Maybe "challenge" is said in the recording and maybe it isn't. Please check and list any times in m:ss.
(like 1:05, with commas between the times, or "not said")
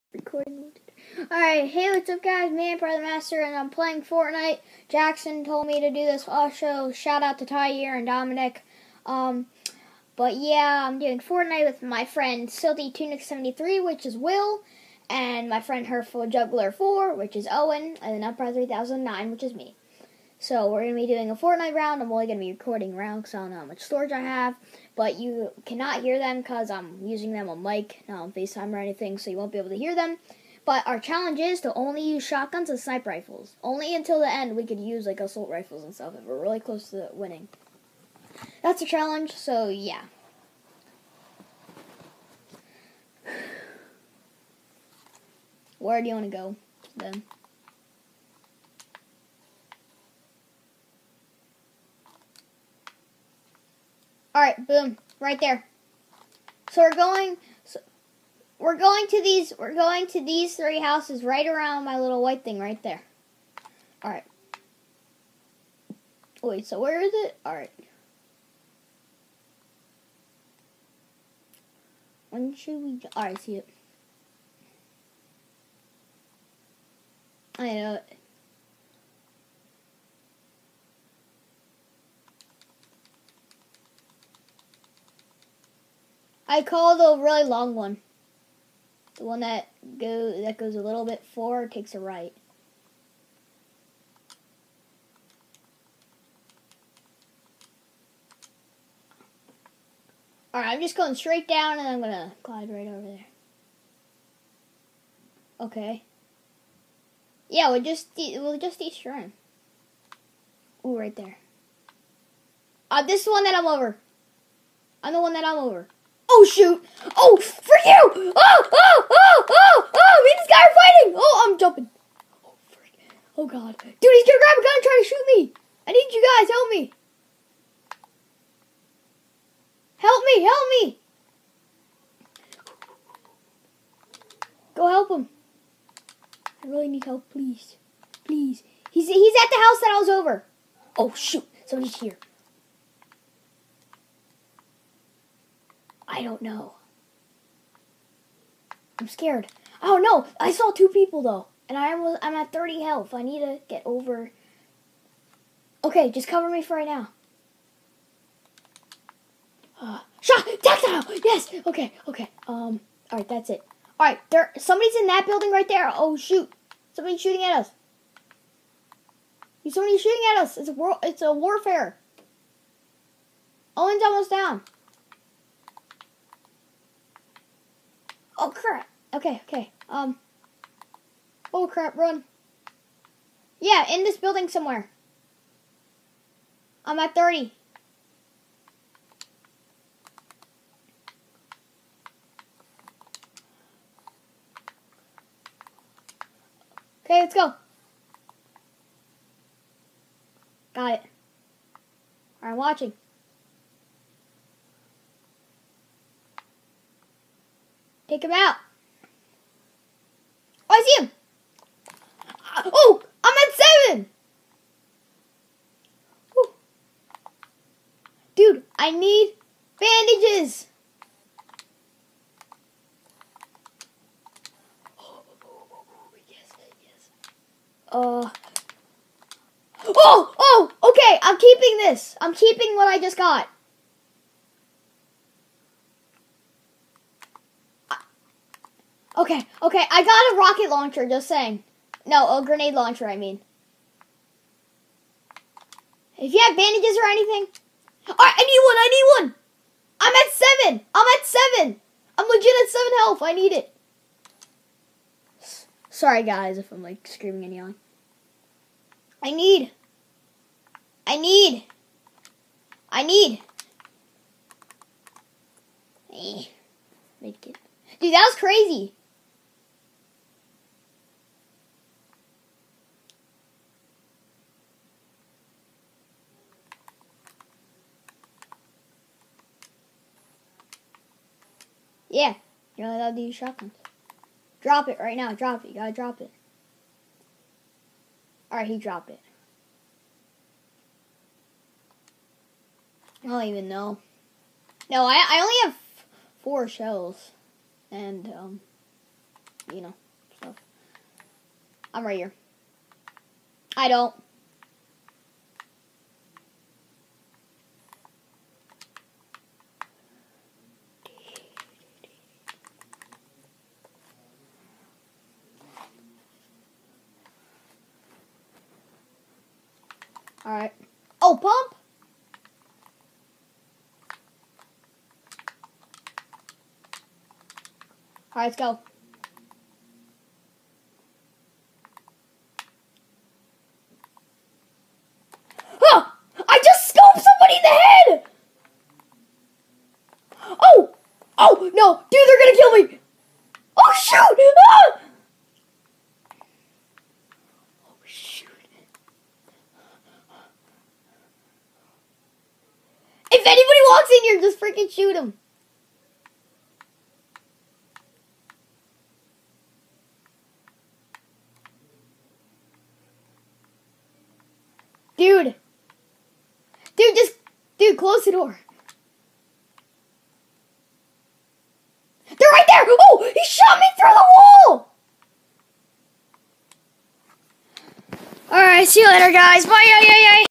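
0:30, 0:38.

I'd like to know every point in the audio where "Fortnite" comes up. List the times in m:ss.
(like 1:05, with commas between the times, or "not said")
0:04, 0:11, 0:21.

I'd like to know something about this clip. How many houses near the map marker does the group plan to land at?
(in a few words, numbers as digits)
3.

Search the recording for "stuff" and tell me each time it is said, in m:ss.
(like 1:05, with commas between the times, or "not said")
0:35, 5:00.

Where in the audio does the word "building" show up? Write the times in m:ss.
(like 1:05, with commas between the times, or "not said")
2:45, 3:04.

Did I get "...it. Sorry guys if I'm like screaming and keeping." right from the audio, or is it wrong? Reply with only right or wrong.
wrong.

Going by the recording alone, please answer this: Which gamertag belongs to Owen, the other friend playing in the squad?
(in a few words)
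Herful Juggler 4.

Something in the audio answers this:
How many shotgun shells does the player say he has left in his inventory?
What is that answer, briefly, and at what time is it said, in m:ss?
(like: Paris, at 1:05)
4, at 4:56.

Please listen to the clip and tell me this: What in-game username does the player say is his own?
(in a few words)
Empire 3009.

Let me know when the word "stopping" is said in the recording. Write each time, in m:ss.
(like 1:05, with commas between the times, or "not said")
not said.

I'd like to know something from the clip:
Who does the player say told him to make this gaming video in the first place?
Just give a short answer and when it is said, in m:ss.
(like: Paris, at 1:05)
Jackson, at 0:04.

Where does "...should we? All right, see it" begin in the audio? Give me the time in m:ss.
1:12.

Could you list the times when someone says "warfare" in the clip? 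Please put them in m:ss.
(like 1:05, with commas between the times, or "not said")
2:51.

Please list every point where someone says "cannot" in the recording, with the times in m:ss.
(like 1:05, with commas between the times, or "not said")
0:25.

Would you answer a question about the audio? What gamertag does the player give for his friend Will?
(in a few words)
Silty Tunic 73.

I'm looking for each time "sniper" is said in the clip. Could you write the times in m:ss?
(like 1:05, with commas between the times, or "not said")
0:32.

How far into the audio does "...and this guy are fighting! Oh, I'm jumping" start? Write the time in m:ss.
2:00.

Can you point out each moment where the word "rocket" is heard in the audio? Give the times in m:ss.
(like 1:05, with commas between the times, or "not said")
4:00.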